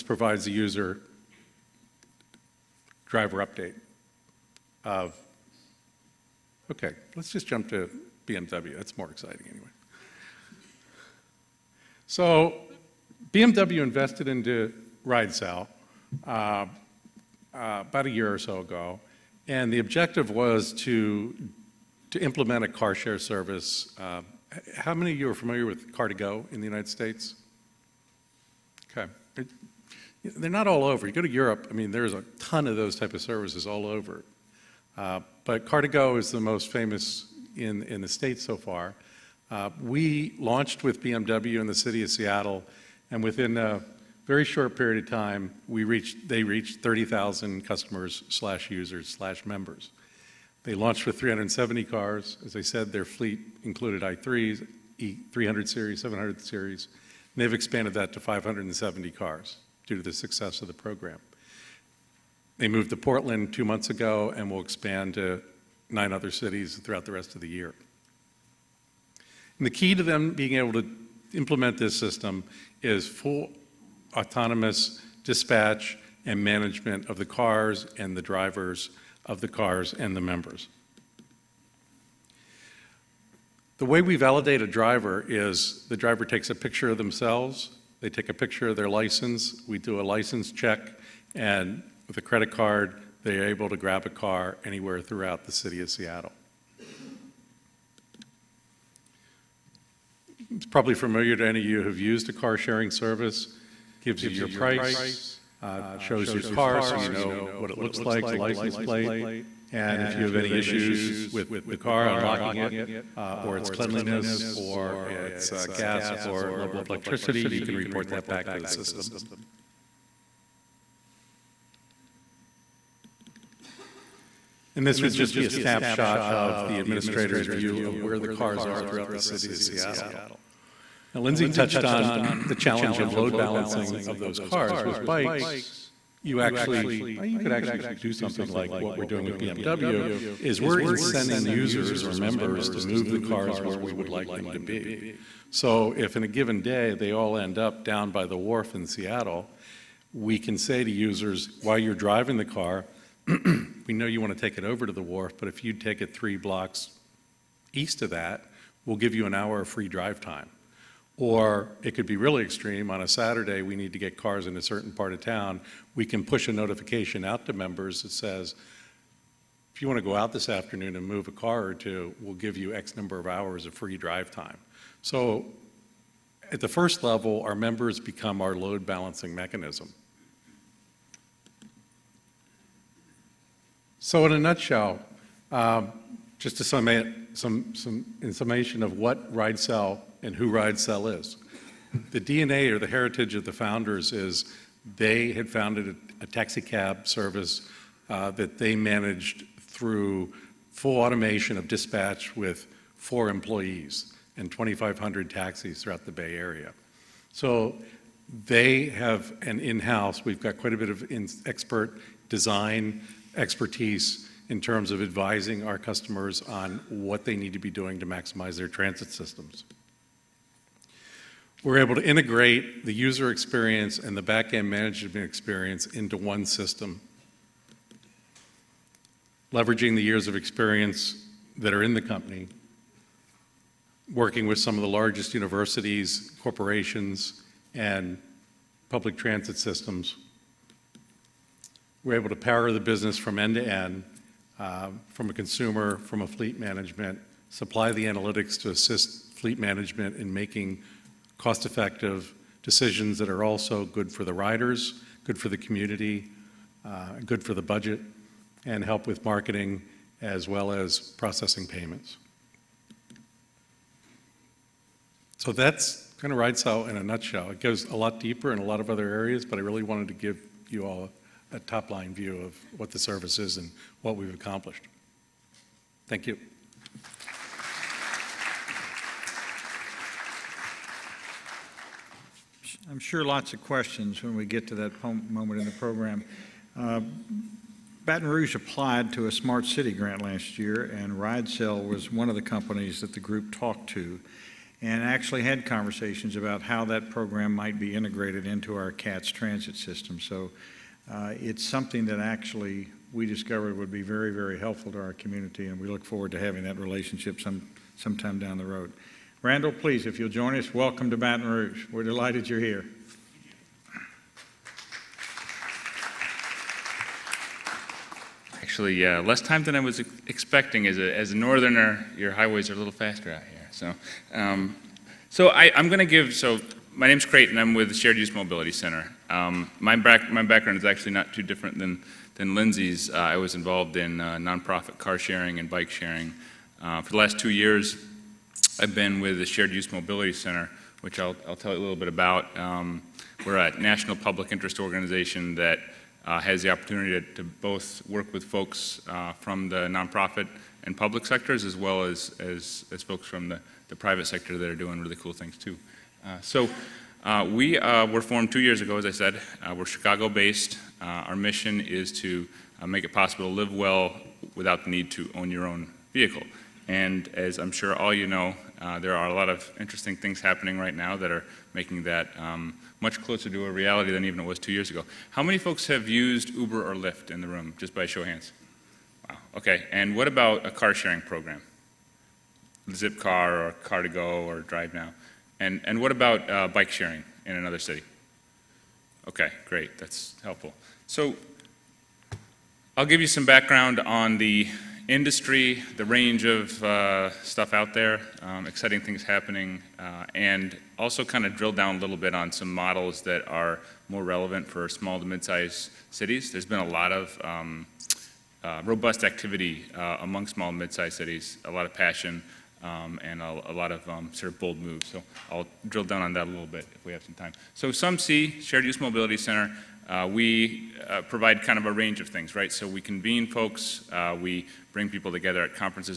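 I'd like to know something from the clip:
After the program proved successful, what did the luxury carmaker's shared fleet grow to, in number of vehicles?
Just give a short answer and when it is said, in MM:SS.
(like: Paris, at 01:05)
570, at 00:58.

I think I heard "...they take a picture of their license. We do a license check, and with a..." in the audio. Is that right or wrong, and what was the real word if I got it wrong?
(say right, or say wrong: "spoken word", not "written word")
right.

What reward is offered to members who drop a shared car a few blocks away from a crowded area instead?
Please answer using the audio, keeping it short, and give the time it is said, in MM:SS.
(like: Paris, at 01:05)
An hour of free drive time, at 02:39.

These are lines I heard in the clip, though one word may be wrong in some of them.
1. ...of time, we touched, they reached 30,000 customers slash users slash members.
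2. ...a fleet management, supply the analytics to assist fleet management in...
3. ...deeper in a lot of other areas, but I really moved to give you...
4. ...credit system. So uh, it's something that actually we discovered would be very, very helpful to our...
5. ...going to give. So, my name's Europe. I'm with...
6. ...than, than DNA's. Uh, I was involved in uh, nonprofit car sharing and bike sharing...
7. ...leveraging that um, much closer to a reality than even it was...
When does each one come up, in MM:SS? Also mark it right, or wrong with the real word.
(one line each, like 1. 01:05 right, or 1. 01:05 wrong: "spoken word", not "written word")
1. 00:45 wrong: "reached", not "touched"
2. 04:06 right
3. 04:28 wrong: "wanted", not "moved"
4. 04:59 wrong: "transit", not "credit"
5. 05:25 wrong: "Creighton", not "Europe"
6. 05:31 wrong: "Lindsay", not "DNA"
7. 06:11 wrong: "making", not "leveraging".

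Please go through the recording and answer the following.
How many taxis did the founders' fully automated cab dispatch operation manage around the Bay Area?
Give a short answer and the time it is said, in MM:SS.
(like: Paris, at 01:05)
2,500, at 03:24.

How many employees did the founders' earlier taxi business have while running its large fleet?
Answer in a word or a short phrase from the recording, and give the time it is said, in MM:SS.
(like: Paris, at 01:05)
4, at 03:22.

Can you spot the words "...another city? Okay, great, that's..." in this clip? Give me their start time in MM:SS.
06:27.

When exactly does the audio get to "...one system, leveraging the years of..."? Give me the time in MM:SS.
03:46.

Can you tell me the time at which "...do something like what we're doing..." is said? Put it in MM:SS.
02:17.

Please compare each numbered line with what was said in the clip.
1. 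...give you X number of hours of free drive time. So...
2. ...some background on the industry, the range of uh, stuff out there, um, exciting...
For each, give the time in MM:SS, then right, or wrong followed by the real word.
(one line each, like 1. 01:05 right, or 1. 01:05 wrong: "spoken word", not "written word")
1. 02:52 right
2. 06:33 right.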